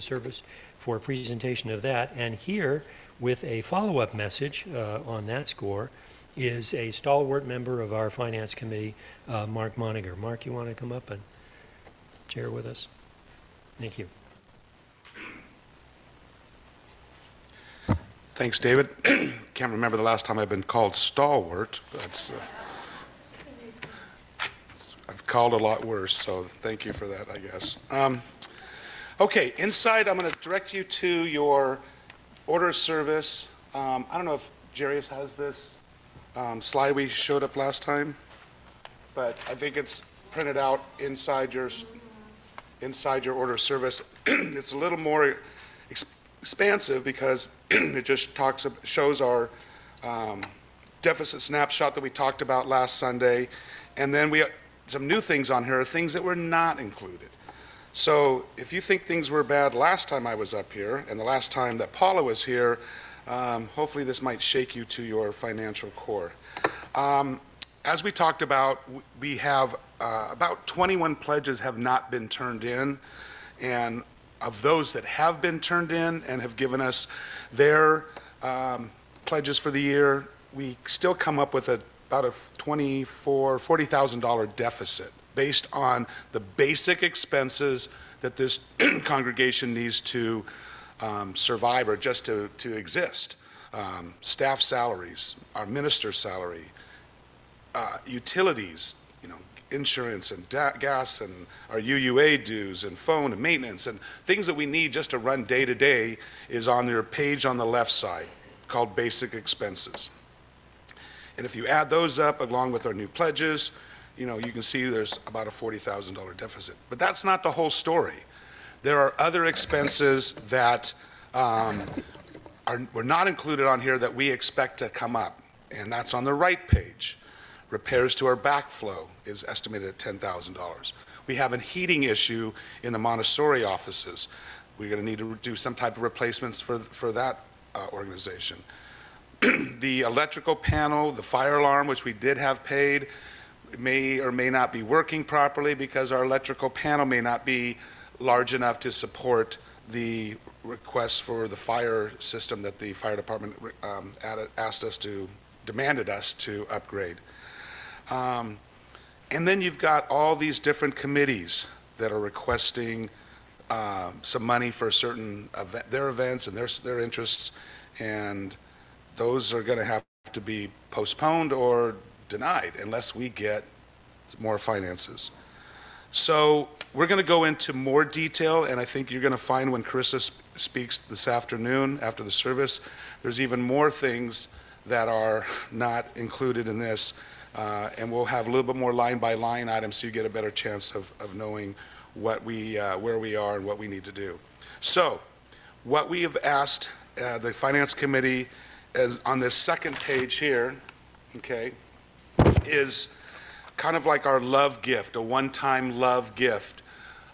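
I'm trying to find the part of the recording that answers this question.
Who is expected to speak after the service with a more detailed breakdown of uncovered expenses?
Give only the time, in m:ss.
2:59.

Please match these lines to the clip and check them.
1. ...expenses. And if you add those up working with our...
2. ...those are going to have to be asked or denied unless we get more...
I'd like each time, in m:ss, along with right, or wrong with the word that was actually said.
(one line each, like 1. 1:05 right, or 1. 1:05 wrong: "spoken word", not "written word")
1. 1:49 wrong: "along", not "working"
2. 2:49 wrong: "postponed", not "asked".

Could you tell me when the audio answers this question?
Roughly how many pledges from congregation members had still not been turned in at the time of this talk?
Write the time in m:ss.
1:10.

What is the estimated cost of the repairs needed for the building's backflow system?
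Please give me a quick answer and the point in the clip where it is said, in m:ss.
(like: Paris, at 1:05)
$10,000, at 2:09.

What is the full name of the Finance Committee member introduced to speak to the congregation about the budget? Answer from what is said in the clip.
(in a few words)
Mark Moniger.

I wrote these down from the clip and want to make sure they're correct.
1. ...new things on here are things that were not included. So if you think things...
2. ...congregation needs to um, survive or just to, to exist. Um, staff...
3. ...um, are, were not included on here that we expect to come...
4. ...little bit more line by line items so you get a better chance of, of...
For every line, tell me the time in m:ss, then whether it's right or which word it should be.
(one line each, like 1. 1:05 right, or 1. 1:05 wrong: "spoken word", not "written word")
1. 0:55 right
2. 1:29 right
3. 2:01 right
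4. 3:08 right.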